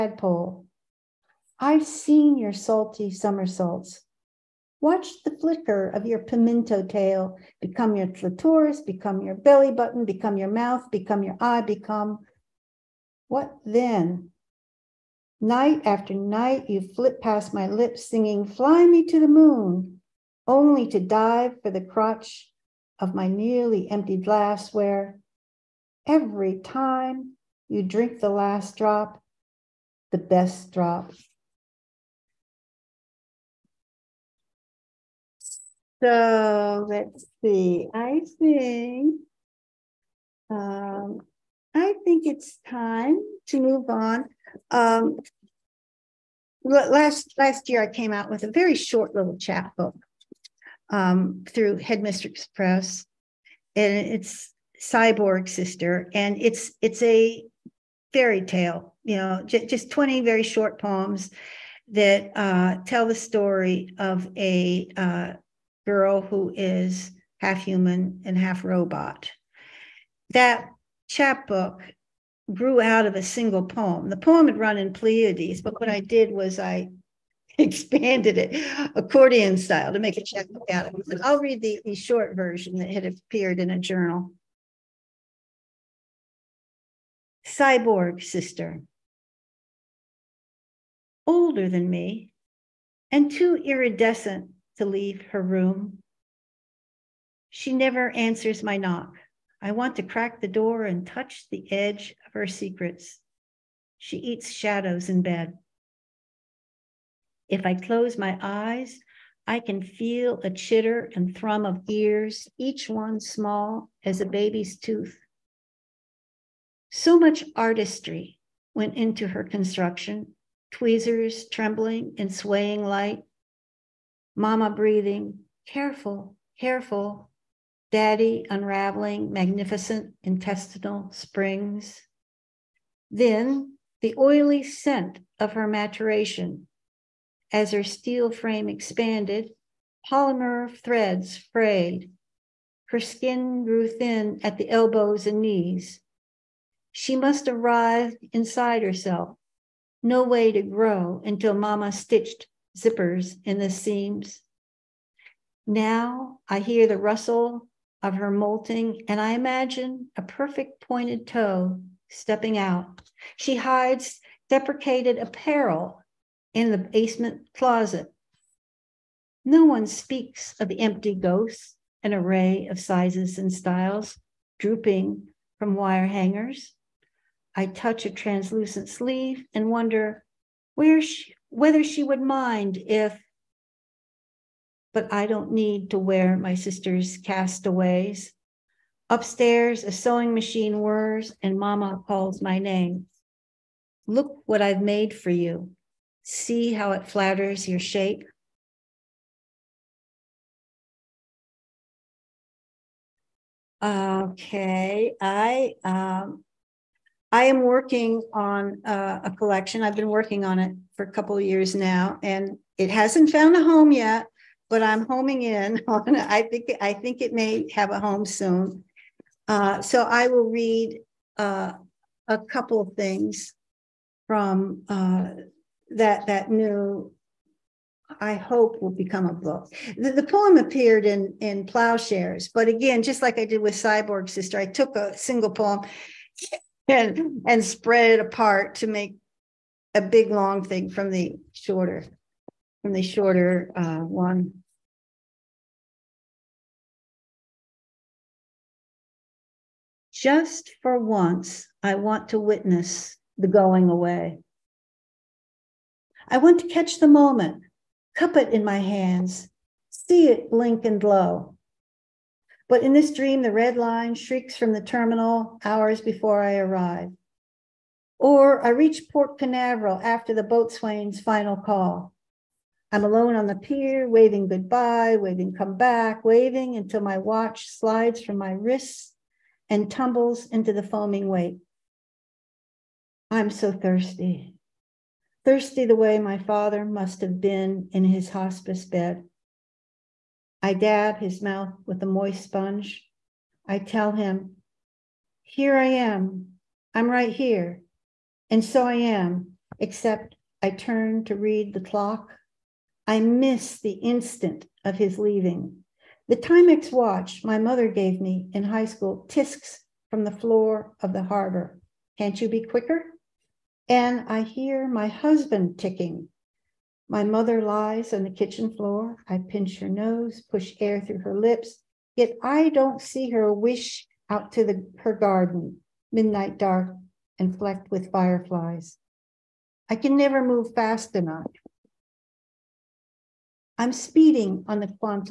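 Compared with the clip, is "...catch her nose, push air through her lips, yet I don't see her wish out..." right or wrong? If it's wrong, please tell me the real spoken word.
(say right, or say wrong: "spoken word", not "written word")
wrong: "pinch", not "catch".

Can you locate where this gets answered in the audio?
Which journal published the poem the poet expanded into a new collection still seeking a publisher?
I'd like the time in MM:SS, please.
03:51.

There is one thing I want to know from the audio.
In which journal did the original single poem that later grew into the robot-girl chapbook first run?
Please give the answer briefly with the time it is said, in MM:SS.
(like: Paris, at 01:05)
Pleiades, at 01:14.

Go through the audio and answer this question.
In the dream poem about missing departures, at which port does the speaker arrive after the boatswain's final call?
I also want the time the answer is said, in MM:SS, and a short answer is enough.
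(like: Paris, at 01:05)
Port Canaveral, at 04:29.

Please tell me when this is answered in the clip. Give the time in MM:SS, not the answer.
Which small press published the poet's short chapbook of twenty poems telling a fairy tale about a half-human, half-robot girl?
00:51.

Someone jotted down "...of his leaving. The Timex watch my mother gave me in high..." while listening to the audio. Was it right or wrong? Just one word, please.
right.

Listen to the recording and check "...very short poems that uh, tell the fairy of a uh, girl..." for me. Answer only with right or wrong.
wrong.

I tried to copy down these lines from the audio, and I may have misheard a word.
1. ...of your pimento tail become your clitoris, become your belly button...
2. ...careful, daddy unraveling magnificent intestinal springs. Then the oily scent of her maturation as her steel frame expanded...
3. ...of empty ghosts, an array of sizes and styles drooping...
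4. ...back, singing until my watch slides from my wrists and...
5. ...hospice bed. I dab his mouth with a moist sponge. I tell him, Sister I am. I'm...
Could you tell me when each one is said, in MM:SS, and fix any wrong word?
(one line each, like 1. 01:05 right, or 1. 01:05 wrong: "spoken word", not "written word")
1. 00:05 right
2. 02:06 right
3. 02:50 right
4. 04:35 wrong: "waving", not "singing"
5. 04:48 wrong: "Here", not "Sister".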